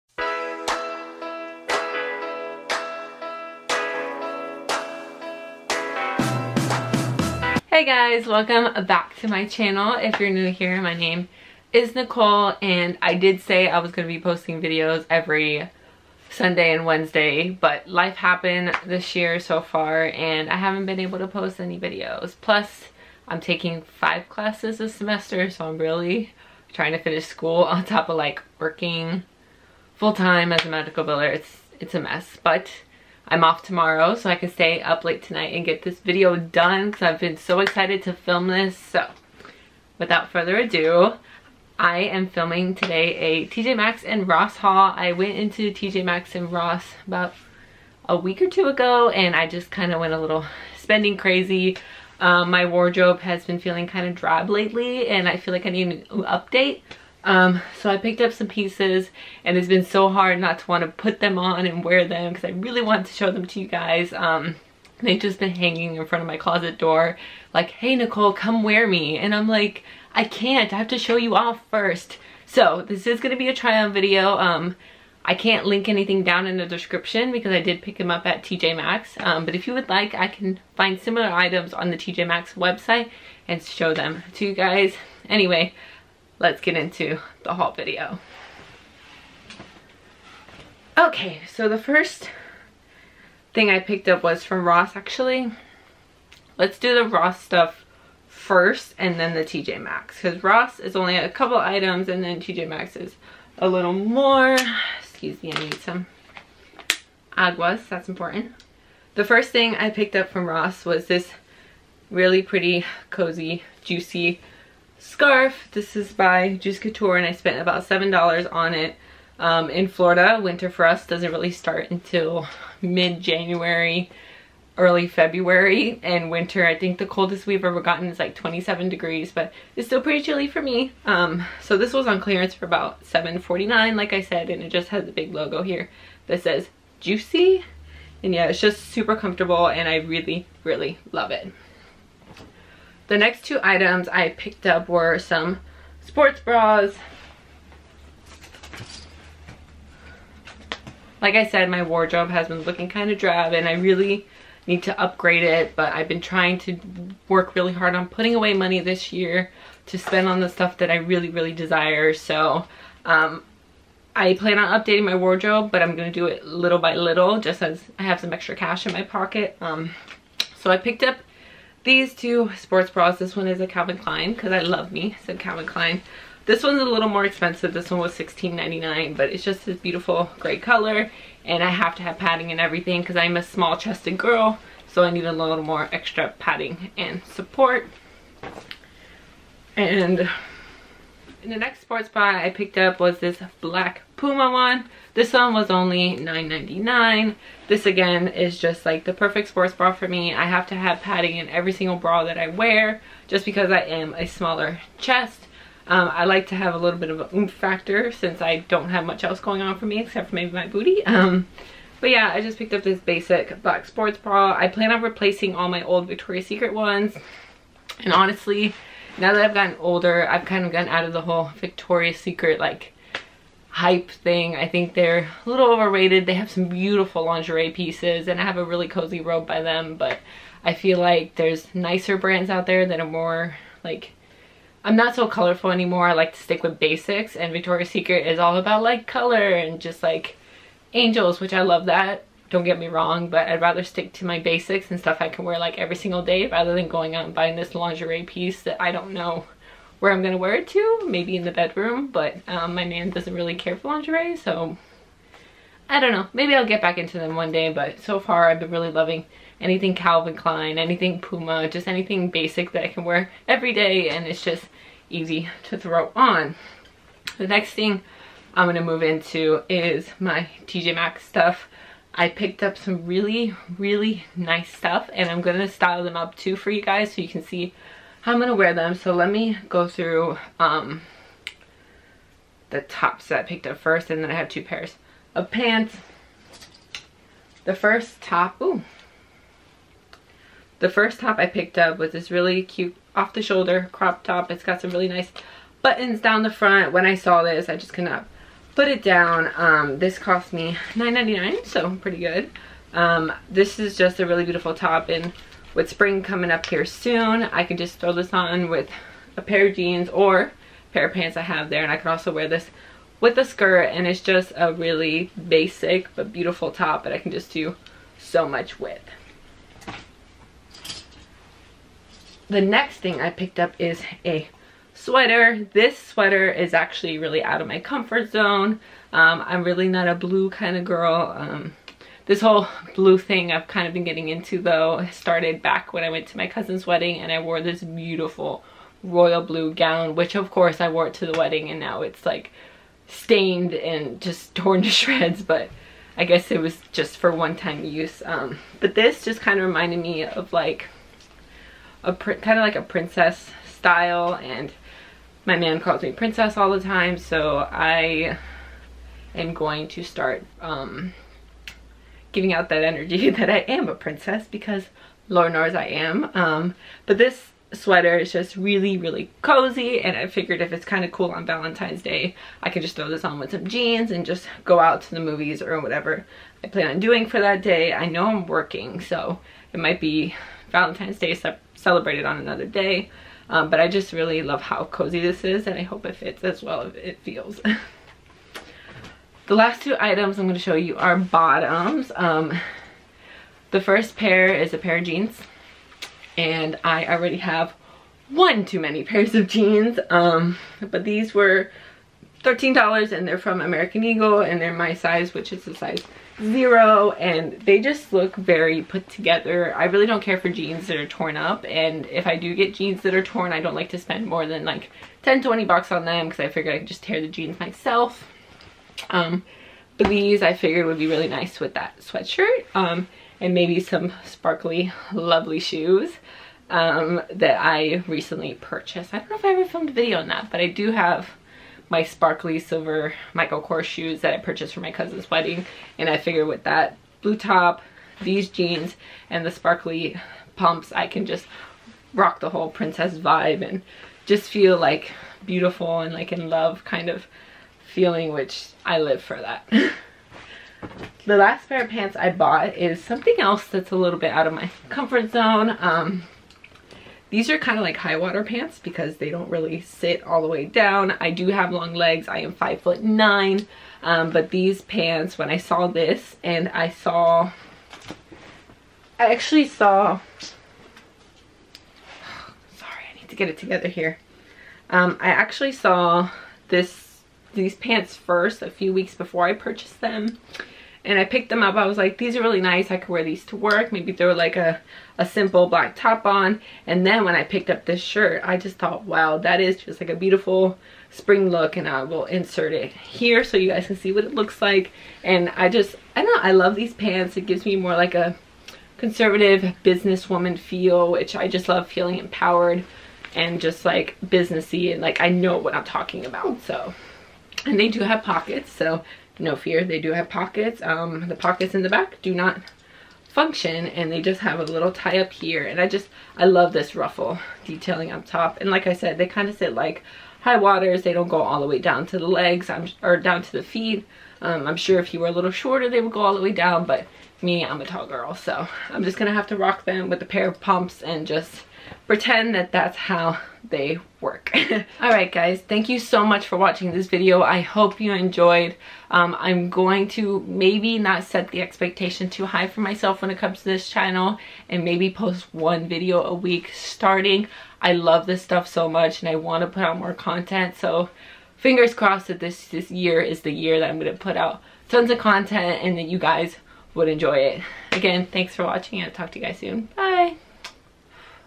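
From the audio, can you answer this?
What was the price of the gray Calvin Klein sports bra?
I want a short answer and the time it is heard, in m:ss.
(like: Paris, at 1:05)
$16.99, at 2:58.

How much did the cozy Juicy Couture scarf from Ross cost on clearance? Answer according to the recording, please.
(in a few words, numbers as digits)
$7.49.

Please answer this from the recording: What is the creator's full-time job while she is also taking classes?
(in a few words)
Medical biller.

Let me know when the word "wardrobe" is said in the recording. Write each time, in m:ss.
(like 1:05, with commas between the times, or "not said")
0:52, 2:31, 2:45.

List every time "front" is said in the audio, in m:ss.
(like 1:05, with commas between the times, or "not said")
1:06, 4:56.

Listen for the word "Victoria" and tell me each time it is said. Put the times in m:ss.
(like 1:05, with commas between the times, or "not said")
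3:36, 3:41, 3:57.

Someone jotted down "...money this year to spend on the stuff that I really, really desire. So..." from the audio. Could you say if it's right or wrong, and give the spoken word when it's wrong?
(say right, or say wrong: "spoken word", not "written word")
right.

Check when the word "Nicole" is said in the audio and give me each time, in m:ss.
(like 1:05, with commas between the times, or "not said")
0:11, 1:07.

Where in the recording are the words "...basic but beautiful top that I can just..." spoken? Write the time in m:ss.
5:15.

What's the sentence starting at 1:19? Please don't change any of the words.
Um, but if you would like, I can find similar items on the TJ Maxx website and show them to you guys.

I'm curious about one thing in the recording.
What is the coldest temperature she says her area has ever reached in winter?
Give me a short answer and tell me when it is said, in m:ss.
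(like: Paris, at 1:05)
27 degrees, at 2:08.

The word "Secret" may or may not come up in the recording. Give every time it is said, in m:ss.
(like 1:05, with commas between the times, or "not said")
3:36, 3:42, 3:57.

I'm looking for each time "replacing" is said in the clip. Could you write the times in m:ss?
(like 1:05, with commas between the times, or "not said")
3:35.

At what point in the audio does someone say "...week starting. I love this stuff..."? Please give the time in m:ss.
9:06.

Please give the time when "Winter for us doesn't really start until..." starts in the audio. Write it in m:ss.
2:00.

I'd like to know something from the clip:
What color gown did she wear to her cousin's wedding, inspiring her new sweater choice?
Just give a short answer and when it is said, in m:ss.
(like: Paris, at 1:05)
Royal blue, at 5:39.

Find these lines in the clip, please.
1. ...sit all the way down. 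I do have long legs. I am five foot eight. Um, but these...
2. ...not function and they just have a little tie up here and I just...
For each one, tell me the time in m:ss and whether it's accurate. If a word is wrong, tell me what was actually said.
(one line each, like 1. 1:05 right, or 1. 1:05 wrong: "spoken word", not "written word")
1. 7:39 wrong: "nine", not "eight"
2. 8:32 right.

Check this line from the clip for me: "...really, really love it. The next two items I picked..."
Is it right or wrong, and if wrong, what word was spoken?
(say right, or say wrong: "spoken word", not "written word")
right.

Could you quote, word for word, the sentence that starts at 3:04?
So I need a little more extra padding and support.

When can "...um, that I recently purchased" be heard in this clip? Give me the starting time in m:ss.
7:06.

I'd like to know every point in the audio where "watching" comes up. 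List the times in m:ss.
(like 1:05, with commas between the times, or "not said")
8:56, 9:18.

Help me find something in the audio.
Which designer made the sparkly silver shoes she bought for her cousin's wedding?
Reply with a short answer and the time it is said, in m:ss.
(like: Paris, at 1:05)
Michael Kors, at 7:13.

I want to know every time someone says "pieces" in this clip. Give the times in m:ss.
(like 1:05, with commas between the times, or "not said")
0:58, 3:47, 4:08.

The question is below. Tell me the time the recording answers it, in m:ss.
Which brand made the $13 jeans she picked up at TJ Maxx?
6:43.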